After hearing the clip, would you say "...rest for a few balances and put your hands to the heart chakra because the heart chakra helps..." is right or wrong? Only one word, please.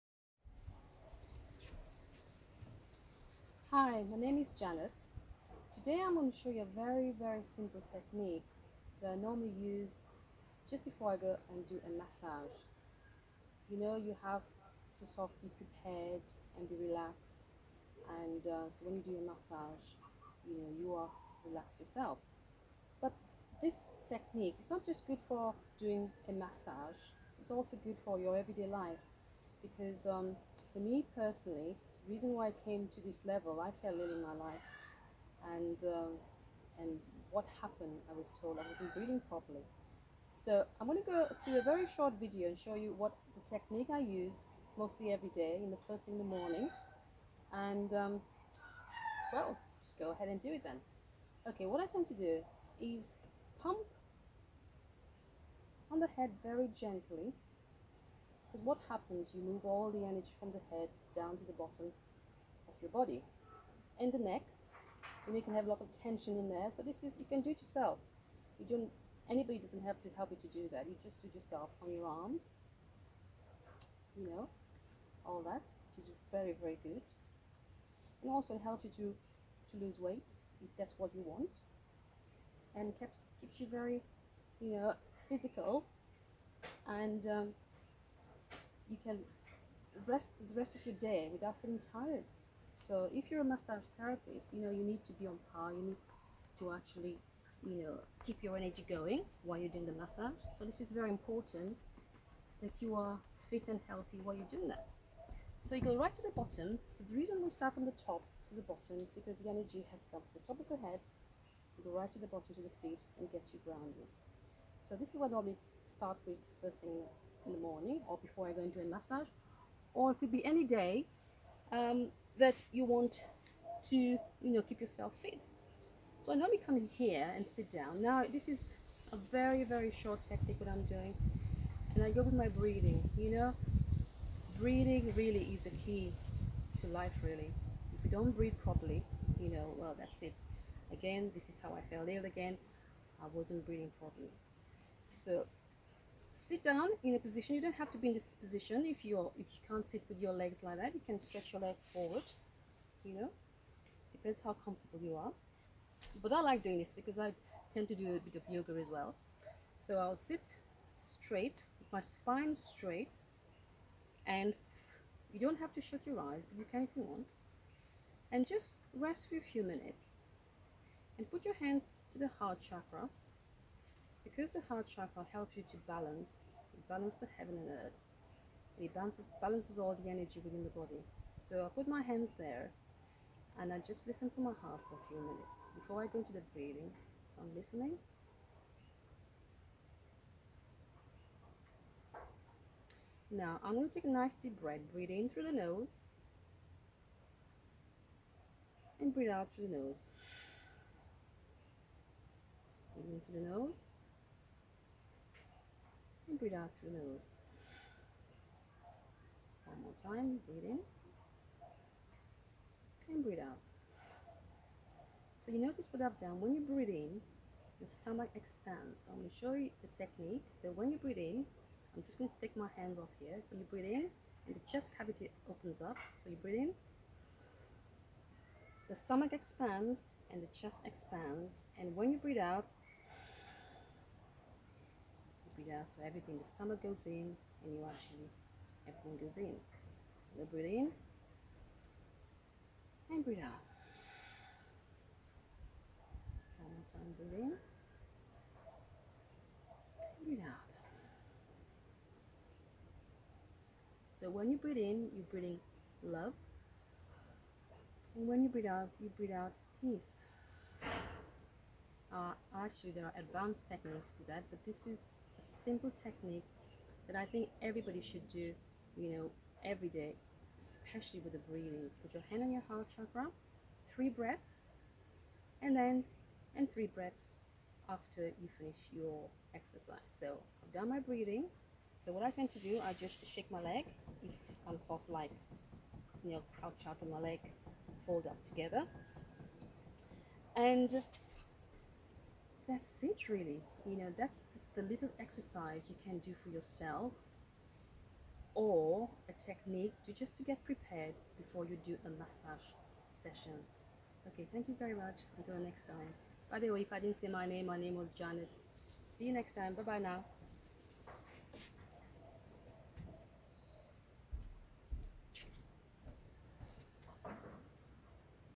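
wrong.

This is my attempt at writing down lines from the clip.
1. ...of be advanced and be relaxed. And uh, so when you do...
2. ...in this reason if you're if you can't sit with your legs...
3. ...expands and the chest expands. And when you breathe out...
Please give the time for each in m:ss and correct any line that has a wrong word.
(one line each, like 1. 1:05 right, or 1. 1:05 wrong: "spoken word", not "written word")
1. 0:15 wrong: "prepared", not "advanced"
2. 2:28 wrong: "position", not "reason"
3. 3:49 right.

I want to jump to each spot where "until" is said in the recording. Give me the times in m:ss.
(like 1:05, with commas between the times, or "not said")
5:05.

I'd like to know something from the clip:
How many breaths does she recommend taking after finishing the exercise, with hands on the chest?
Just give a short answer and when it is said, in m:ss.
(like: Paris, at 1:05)
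3, at 4:36.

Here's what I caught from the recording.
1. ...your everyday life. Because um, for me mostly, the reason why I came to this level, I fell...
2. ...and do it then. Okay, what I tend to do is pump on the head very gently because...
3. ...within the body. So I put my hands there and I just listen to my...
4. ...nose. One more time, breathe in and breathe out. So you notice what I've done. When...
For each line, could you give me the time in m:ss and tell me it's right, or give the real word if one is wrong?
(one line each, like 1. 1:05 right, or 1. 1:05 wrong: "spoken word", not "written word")
1. 0:28 wrong: "personally", not "mostly"
2. 0:50 right
3. 3:00 right
4. 3:26 right.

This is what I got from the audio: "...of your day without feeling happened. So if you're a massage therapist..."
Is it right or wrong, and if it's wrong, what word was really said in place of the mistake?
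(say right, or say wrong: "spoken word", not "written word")
wrong: "tired", not "happened".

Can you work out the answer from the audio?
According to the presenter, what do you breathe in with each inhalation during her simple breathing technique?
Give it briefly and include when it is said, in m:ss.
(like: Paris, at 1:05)
Love, at 4:16.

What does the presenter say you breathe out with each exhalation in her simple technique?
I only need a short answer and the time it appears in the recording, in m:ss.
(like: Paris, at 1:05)
Peace, at 4:19.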